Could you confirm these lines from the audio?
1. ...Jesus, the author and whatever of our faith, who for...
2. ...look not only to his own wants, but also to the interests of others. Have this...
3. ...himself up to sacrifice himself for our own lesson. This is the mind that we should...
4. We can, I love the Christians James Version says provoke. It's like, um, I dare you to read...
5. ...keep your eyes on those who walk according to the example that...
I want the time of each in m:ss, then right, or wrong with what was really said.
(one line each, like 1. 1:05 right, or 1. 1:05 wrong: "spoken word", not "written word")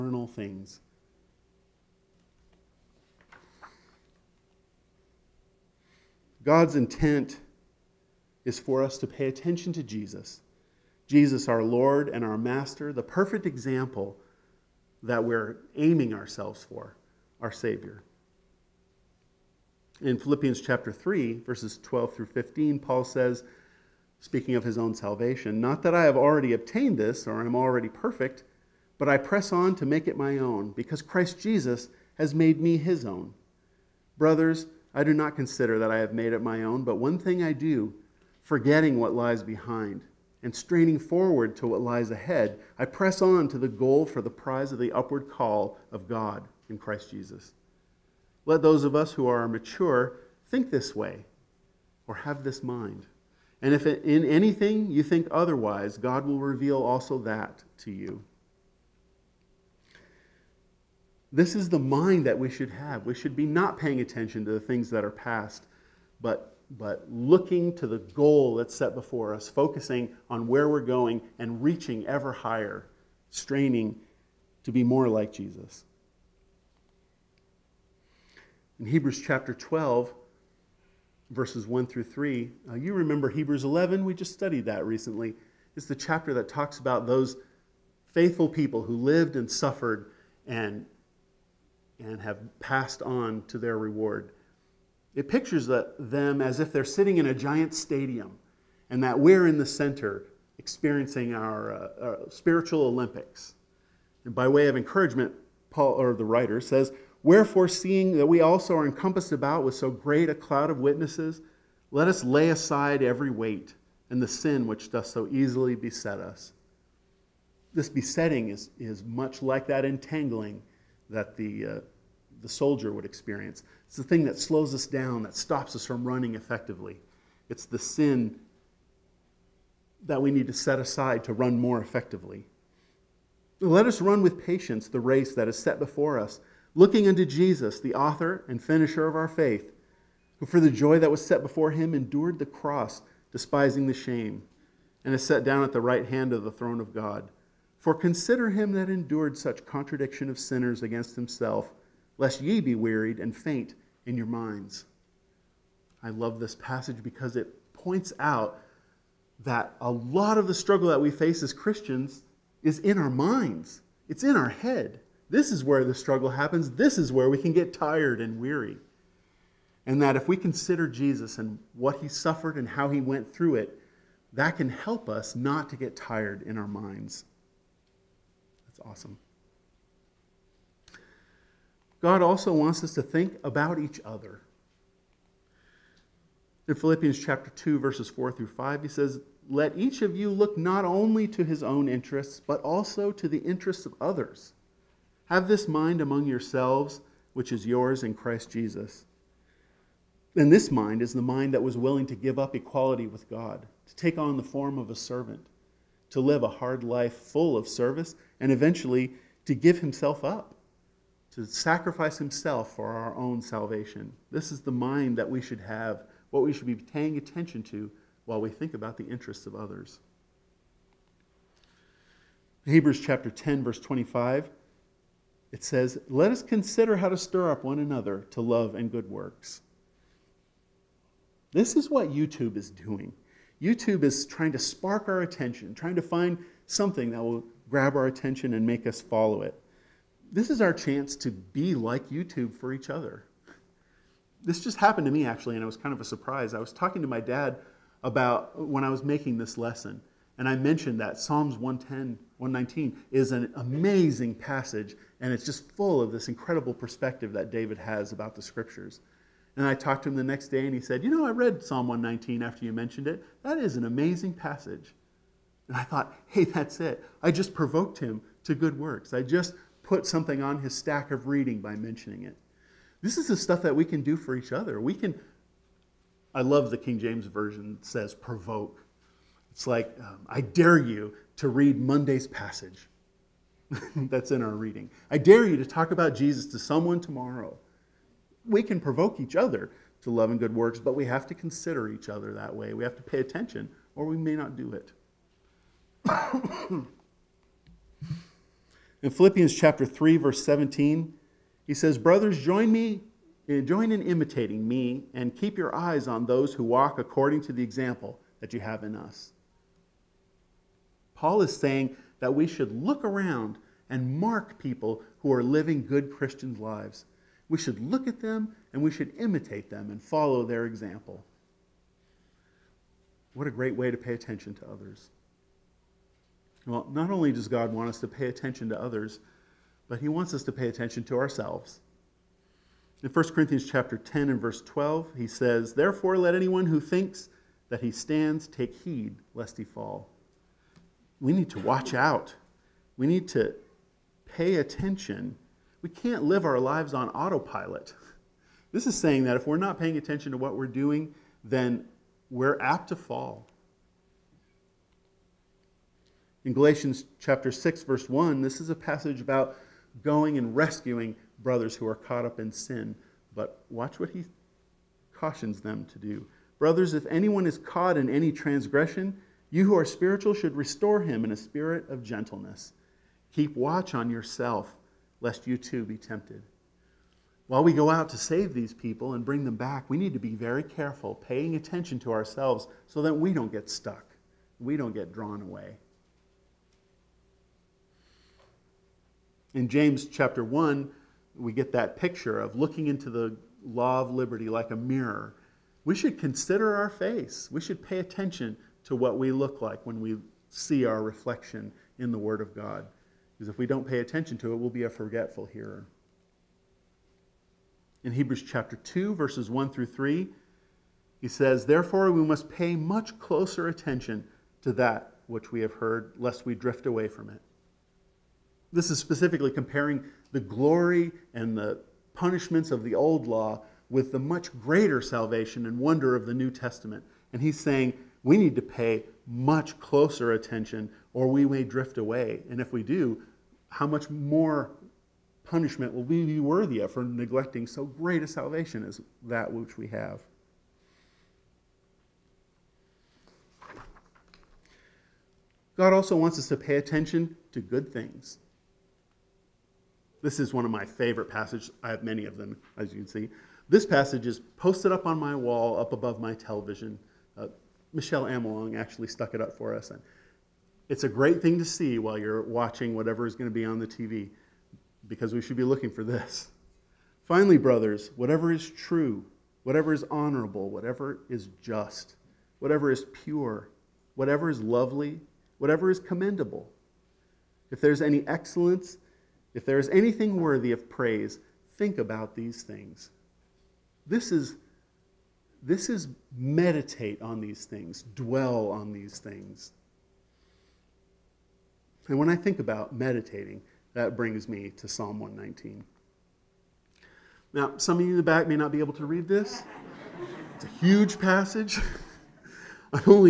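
1. 2:17 wrong: "finisher", not "whatever"
2. 3:10 wrong: "interests", not "wants"
3. 3:29 wrong: "salvation", not "lesson"
4. 4:34 wrong: "King", not "Christians"
5. 5:05 right.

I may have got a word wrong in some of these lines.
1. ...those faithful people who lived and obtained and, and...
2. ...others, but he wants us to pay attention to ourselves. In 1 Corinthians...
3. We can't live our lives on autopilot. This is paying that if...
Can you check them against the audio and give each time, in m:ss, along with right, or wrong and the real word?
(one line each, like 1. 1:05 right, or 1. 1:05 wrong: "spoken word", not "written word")
1. 1:27 wrong: "suffered", not "obtained"
2. 5:28 right
3. 5:45 wrong: "saying", not "paying".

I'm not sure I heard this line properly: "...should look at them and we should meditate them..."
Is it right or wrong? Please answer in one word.
wrong.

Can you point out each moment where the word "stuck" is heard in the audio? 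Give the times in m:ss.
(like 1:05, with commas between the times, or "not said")
6:23, 7:39.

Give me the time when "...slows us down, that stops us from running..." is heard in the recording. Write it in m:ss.
2:04.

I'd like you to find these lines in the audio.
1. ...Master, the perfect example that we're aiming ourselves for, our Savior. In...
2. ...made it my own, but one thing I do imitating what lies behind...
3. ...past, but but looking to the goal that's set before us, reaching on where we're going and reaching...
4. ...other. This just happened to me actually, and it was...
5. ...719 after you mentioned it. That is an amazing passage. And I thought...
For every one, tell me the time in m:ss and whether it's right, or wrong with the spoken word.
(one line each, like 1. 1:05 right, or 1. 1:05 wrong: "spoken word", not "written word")
1. 0:12 right
2. 0:36 wrong: "forgetting", not "imitating"
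3. 1:05 wrong: "focusing", not "reaching"
4. 4:02 right
5. 4:21 wrong: "119", not "719".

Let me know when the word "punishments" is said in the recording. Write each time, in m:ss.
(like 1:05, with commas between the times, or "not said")
7:02, 7:15.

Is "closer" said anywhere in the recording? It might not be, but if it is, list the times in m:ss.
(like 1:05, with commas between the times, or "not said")
6:53, 7:09.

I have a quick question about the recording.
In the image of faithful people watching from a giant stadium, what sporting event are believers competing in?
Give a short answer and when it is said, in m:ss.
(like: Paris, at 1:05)
spiritual Olympics, at 1:42.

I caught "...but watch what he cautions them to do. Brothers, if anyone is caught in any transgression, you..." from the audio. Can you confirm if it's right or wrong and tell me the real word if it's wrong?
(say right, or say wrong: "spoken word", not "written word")
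right.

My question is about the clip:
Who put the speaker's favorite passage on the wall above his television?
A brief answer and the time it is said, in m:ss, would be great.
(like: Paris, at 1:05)
Michelle Amelong, at 7:37.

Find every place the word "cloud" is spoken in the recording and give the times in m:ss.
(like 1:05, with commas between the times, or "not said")
1:50.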